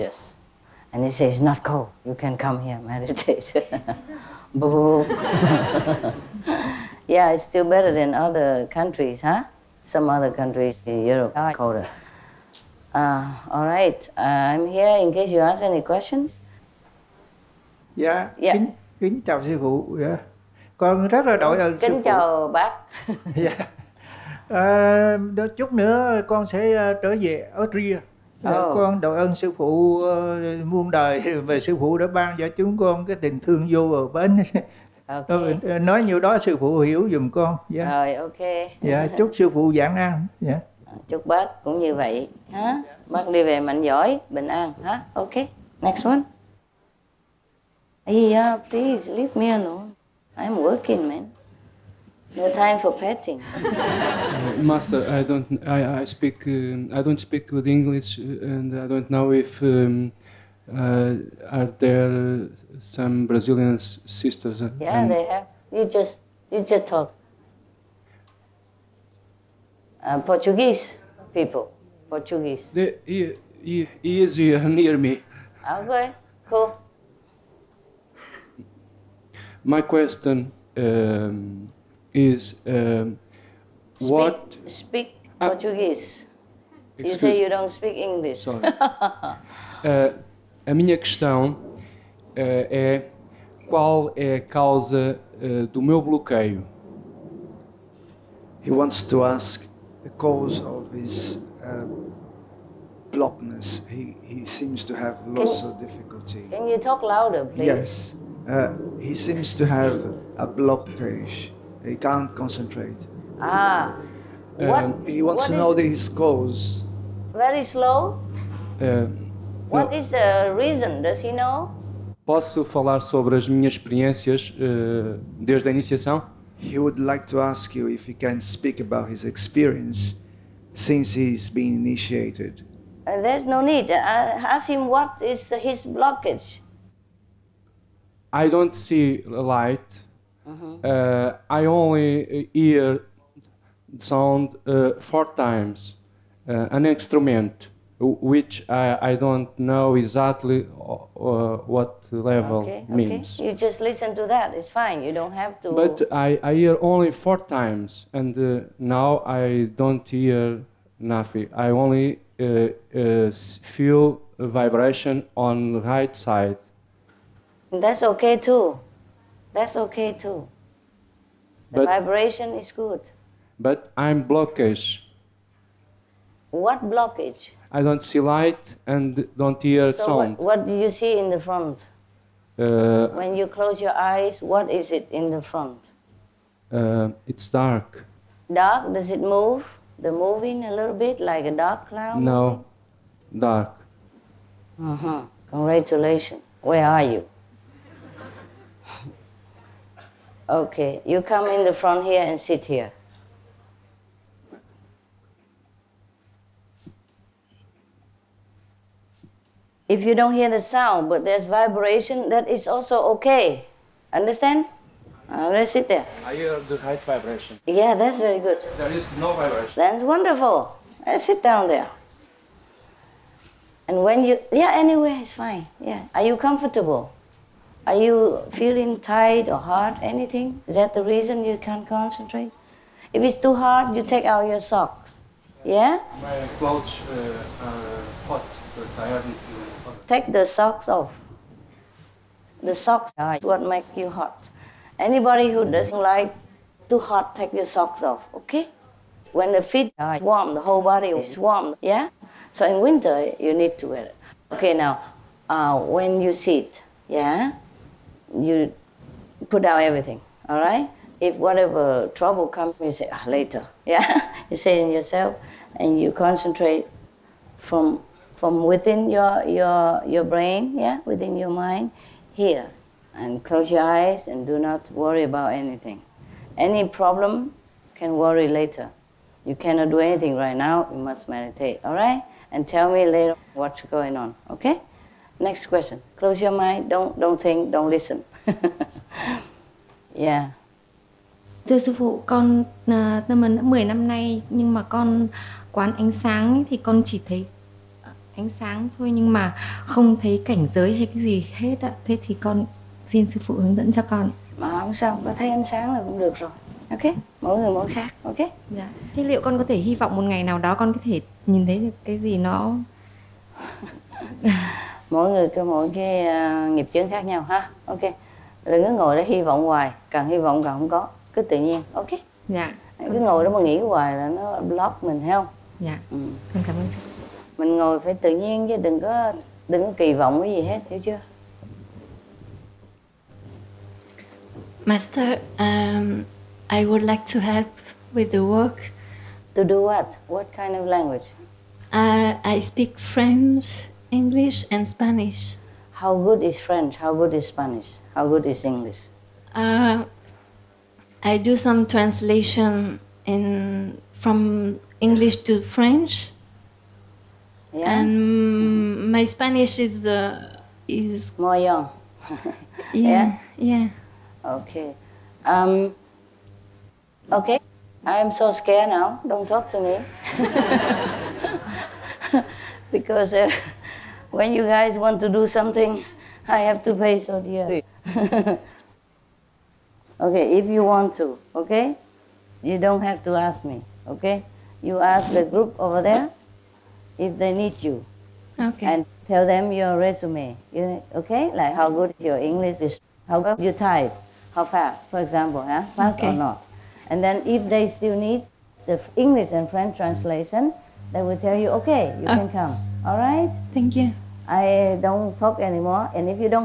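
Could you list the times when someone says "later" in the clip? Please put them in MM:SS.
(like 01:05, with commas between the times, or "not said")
04:23, 04:38, 04:43.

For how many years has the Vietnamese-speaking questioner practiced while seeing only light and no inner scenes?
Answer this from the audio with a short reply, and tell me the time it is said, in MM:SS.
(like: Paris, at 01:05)
10, at 04:53.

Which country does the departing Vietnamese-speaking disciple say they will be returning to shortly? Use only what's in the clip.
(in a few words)
Austria.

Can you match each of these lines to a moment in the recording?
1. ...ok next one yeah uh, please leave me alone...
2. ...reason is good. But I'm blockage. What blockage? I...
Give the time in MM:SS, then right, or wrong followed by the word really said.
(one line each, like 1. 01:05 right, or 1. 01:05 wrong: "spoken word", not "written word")
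1. 00:45 right
2. 02:51 wrong: "vibration", not "reason".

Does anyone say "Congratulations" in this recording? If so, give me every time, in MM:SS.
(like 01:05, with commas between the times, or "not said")
03:15.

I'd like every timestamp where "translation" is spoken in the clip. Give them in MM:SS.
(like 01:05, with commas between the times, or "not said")
05:51, 06:39.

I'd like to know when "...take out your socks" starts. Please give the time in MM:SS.
03:54.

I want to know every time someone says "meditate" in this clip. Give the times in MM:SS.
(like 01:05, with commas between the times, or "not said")
00:02, 04:41.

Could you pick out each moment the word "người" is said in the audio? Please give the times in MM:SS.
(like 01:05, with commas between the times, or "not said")
05:07, 05:15.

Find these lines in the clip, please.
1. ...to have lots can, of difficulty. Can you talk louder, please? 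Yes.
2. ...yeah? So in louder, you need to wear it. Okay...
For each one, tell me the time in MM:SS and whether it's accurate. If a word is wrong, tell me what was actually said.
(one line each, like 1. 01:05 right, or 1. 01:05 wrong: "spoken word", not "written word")
1. 01:44 right
2. 04:11 wrong: "winter", not "louder".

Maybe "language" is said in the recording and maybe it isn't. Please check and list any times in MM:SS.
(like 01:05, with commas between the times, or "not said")
05:40.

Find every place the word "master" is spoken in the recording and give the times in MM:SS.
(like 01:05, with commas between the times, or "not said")
00:54, 05:34.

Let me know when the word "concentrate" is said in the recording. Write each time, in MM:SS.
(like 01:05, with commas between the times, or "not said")
01:52, 03:51, 04:26.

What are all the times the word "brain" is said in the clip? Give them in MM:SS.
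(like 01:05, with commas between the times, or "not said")
04:30.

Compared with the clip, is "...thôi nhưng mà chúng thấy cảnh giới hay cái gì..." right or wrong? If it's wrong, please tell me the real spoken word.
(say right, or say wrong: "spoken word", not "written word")
wrong: "không", not "chúng".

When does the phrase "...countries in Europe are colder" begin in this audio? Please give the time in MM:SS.
00:10.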